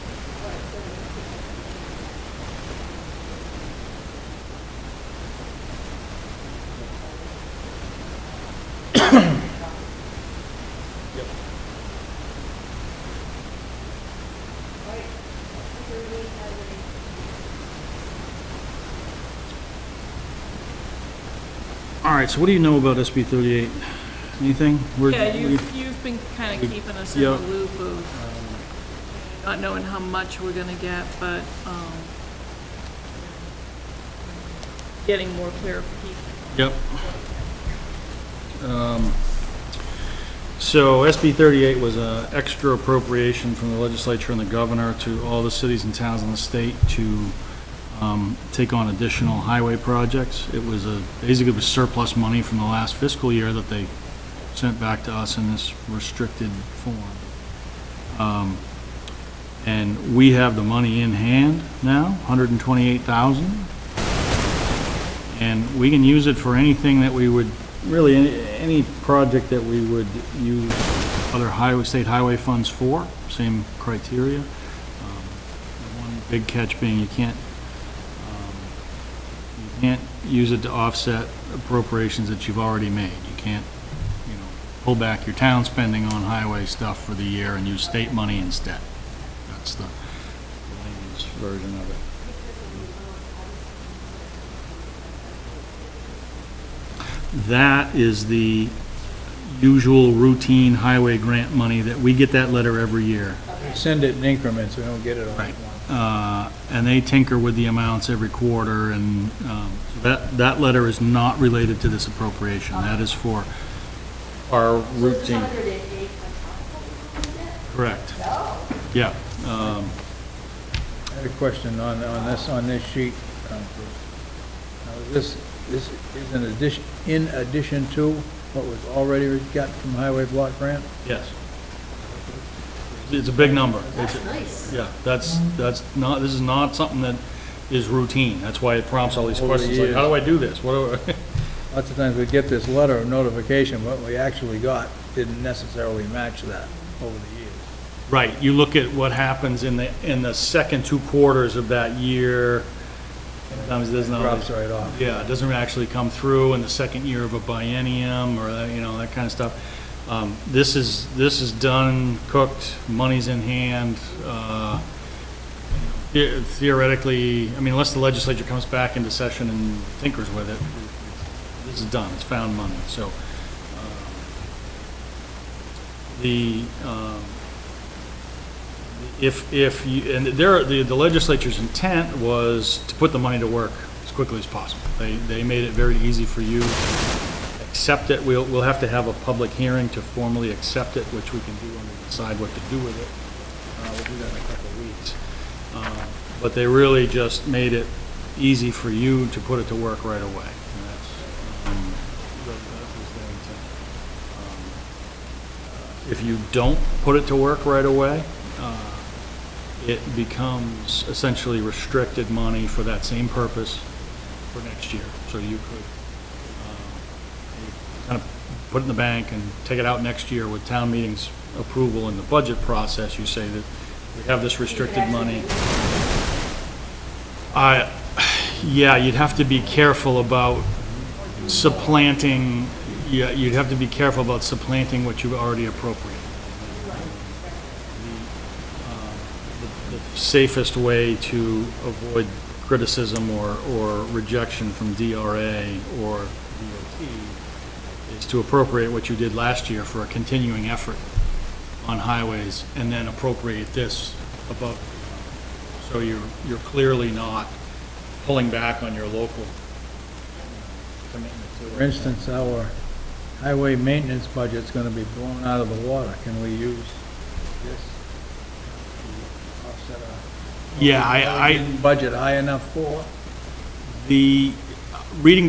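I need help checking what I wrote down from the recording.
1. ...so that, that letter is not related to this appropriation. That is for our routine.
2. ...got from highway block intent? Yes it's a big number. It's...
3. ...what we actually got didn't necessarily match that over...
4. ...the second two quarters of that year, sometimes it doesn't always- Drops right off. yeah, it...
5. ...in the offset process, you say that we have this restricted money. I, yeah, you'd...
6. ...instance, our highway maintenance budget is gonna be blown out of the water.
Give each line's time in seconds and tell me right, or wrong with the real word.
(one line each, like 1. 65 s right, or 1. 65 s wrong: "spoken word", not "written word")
1. 109 s right
2. 129 s wrong: "grant", not "intent"
3. 143 s right
4. 150 s right
5. 222 s wrong: "budget", not "offset"
6. 261 s right.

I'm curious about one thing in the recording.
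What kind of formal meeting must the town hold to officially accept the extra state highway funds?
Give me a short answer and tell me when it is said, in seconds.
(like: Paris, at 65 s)
public hearing, at 189 s.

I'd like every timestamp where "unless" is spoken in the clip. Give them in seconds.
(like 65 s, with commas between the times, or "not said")
167 s.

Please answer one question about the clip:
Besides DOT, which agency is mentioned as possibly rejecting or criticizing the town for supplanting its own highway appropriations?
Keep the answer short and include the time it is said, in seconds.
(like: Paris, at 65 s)
DRA, at 244 s.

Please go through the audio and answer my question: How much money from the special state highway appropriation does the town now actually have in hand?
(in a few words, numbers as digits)
$128,000.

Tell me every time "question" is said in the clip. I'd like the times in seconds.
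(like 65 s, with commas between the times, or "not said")
121 s, 139 s.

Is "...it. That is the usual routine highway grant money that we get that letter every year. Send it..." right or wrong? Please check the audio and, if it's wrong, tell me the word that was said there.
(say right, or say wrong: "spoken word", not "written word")
right.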